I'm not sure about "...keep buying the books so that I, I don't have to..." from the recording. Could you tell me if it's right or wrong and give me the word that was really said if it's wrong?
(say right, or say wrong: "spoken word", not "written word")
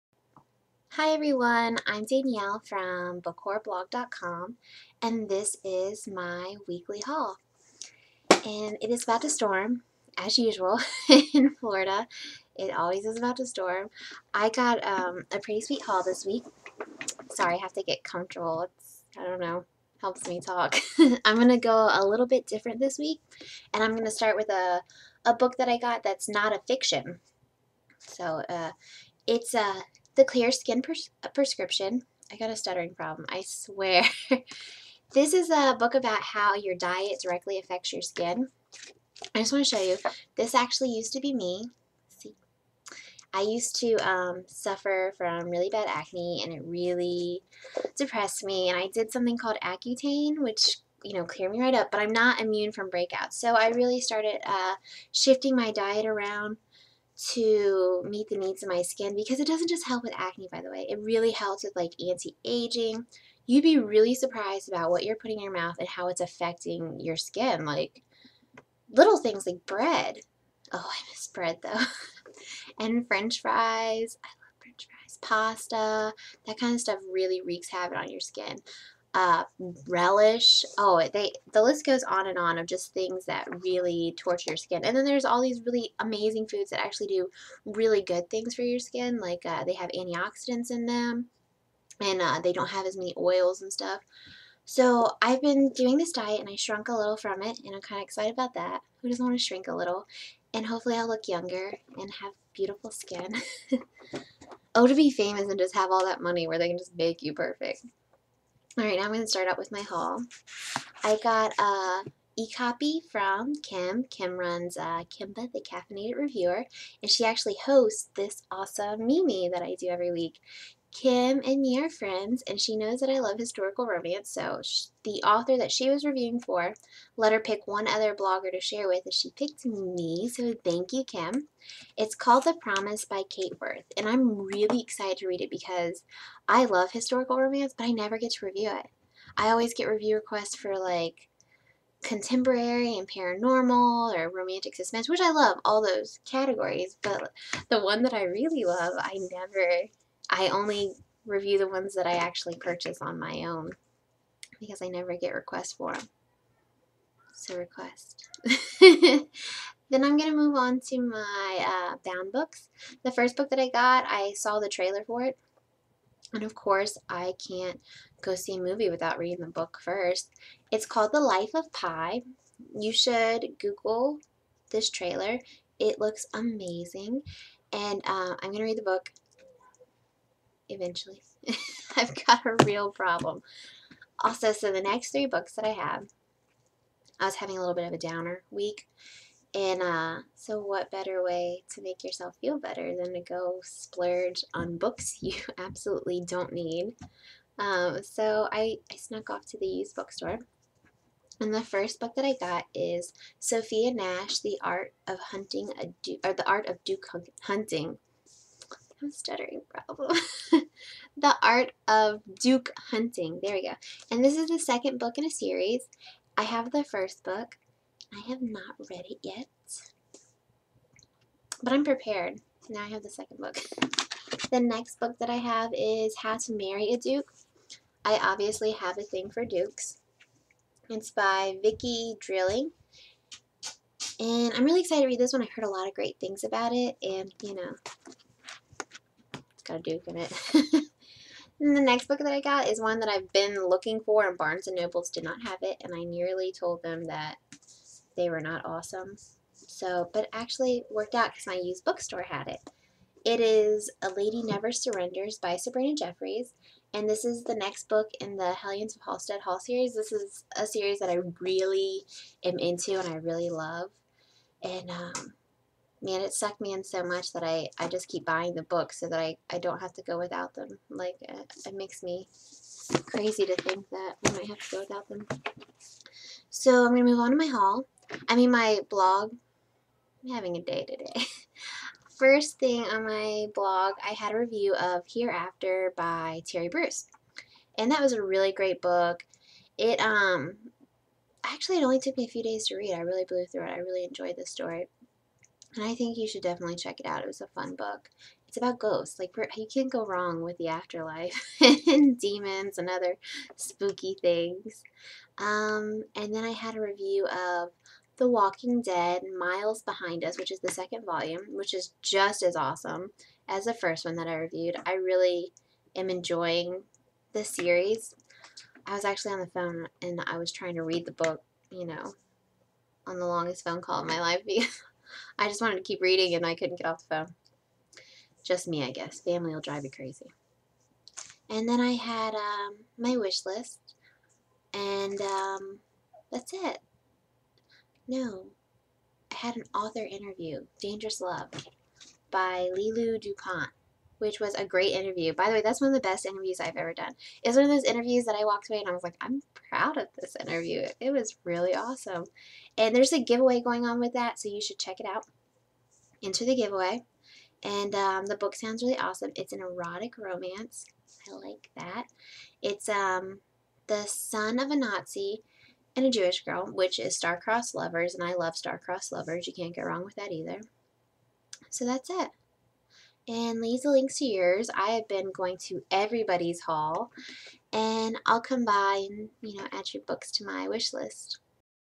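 right.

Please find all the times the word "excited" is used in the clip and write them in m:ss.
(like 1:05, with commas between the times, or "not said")
1:38, 2:14, 3:54.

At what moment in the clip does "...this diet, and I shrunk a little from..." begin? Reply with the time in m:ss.
1:35.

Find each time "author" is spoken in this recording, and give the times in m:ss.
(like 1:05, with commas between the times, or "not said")
2:05, 5:39.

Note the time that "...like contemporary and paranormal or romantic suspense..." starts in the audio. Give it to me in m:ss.
2:20.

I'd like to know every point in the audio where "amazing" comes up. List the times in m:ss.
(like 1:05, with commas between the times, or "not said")
1:25, 2:56.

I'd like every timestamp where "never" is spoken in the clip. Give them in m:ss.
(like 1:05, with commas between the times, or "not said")
2:17, 2:29, 2:34, 4:14.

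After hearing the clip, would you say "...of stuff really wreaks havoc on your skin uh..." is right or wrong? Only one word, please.
right.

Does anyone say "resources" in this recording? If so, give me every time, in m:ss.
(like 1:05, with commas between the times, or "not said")
not said.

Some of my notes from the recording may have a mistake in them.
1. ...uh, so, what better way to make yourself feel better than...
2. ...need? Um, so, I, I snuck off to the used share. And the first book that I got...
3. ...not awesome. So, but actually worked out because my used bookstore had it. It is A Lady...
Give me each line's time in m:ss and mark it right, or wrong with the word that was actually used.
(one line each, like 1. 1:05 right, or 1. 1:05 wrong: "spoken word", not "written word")
1. 3:09 right
2. 3:16 wrong: "bookstore", not "share"
3. 4:08 right.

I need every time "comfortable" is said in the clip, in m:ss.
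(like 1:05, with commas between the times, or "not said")
0:18.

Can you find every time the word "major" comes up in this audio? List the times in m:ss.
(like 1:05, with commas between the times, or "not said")
not said.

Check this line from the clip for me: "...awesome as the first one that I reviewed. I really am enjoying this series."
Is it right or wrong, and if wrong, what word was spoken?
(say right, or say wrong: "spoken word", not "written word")
right.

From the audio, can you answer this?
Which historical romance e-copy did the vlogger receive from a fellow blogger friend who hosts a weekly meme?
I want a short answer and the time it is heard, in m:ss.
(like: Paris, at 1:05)
The Promise, at 2:12.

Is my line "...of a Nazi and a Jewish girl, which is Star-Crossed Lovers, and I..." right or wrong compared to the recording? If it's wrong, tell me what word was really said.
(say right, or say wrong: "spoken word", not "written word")
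right.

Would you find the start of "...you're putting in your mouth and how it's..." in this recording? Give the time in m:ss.
1:05.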